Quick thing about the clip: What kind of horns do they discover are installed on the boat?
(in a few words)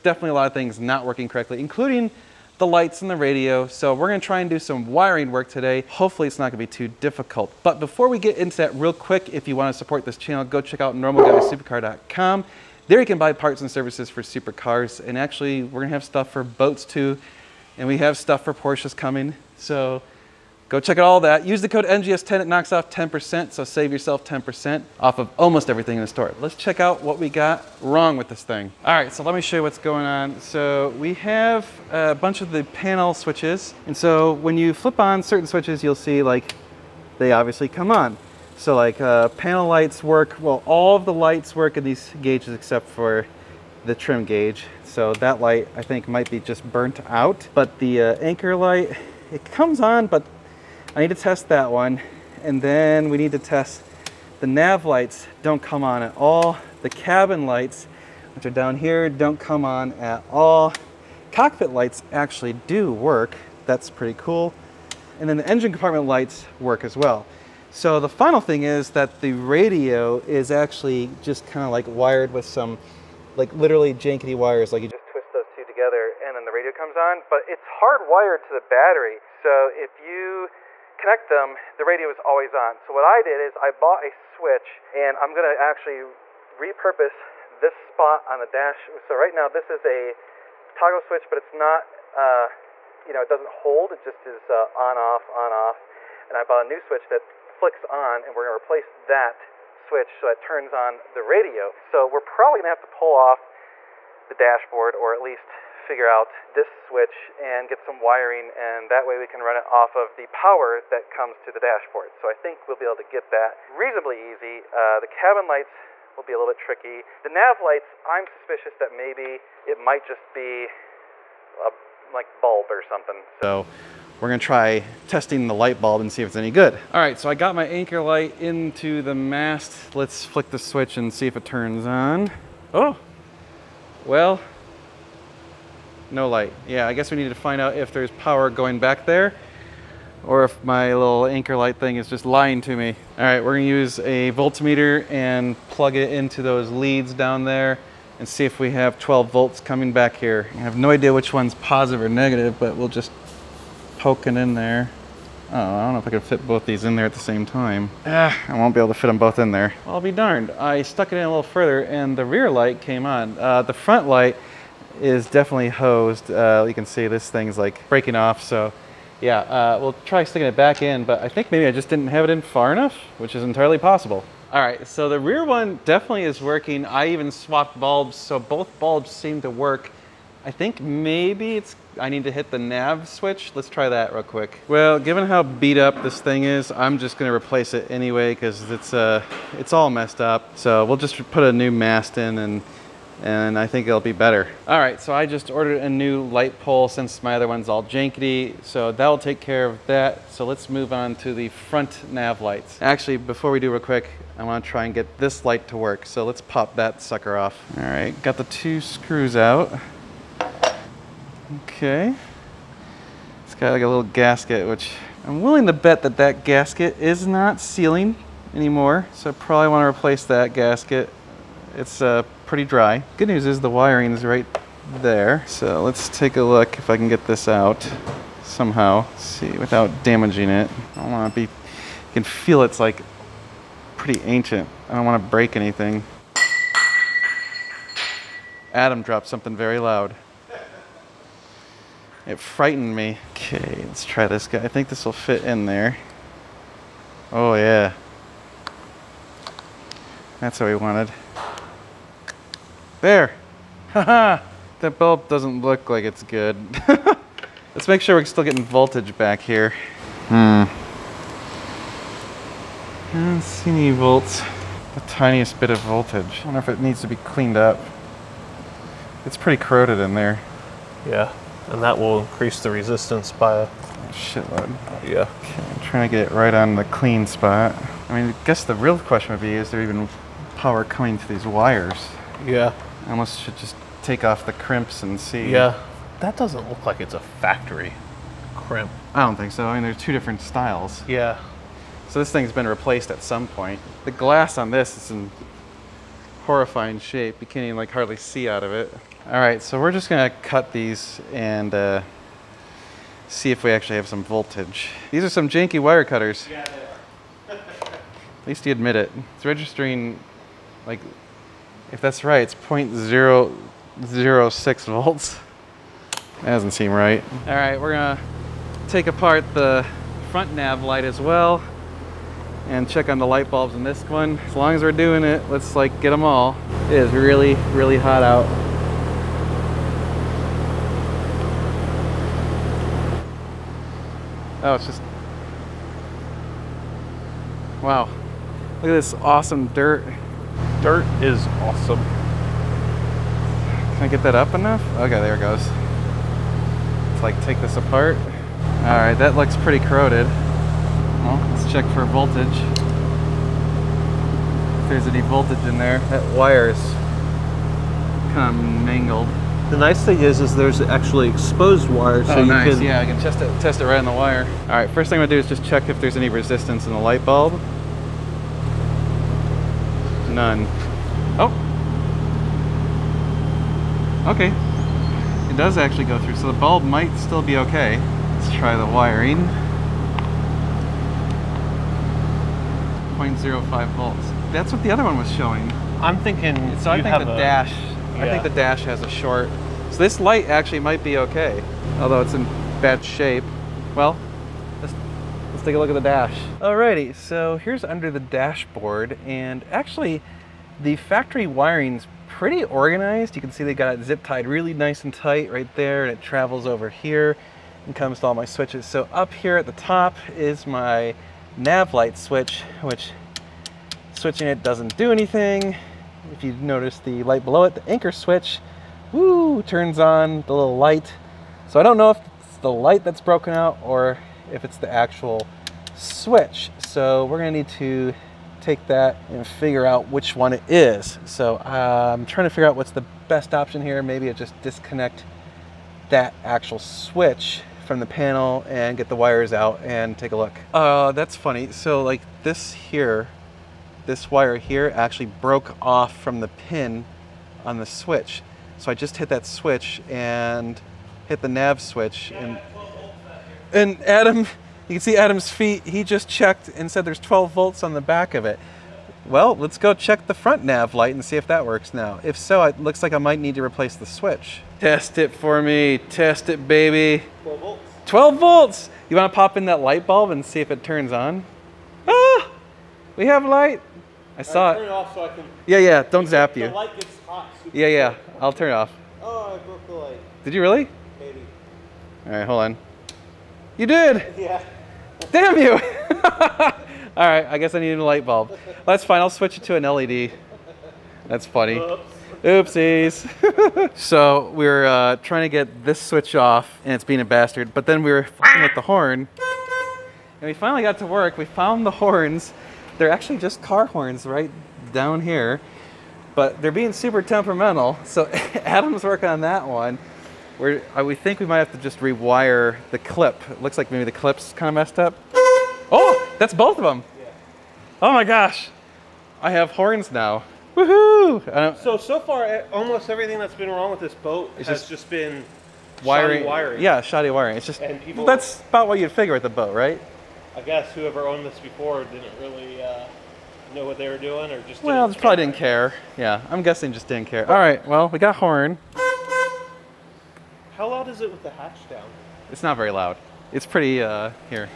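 car horns.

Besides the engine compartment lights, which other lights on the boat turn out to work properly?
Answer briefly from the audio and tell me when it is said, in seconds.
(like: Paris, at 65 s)
Cockpit lights, at 61 s.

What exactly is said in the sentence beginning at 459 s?
Well, let's go check the front nav light and see if that works now.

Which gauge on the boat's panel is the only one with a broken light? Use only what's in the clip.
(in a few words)
trim gauge.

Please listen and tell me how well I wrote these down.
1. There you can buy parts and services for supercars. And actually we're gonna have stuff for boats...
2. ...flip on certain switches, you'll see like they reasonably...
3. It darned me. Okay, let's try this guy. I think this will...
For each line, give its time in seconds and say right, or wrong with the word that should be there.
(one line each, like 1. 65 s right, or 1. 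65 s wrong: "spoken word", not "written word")
1. 12 s right
2. 34 s wrong: "obviously", not "reasonably"
3. 242 s wrong: "frightened", not "darned".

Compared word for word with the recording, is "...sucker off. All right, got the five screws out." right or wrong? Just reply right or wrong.
wrong.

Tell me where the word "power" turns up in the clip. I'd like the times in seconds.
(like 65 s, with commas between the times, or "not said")
110 s, 138 s, 280 s.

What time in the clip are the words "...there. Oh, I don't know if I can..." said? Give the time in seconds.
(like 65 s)
154 s.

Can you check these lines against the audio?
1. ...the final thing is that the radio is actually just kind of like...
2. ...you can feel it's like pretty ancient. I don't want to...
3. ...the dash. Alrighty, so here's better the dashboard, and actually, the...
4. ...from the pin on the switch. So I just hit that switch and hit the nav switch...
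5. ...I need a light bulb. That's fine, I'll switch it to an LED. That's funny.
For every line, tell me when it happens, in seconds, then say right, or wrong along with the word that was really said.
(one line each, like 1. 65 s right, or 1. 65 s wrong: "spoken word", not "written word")
1. 67 s right
2. 231 s right
3. 395 s wrong: "under", not "better"
4. 446 s right
5. 487 s right.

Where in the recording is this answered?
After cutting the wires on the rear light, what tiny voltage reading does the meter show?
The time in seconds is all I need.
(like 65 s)
313 s.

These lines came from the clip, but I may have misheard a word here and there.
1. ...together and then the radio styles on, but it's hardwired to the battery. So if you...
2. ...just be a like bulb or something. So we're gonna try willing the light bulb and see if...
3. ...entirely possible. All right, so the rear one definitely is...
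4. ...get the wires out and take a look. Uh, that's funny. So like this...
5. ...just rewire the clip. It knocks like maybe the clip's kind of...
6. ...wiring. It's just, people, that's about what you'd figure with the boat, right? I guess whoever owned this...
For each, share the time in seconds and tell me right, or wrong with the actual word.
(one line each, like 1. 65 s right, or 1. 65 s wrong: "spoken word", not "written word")
1. 75 s wrong: "comes", not "styles"
2. 120 s wrong: "testing", not "willing"
3. 173 s right
4. 438 s right
5. 511 s wrong: "looks", not "knocks"
6. 527 s right.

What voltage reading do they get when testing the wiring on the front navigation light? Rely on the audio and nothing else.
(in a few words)
0.05 volts.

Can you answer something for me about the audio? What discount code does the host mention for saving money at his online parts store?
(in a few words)
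NGS10.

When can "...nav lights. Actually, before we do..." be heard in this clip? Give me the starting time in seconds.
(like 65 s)
202 s.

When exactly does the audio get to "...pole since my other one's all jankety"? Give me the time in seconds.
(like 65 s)
196 s.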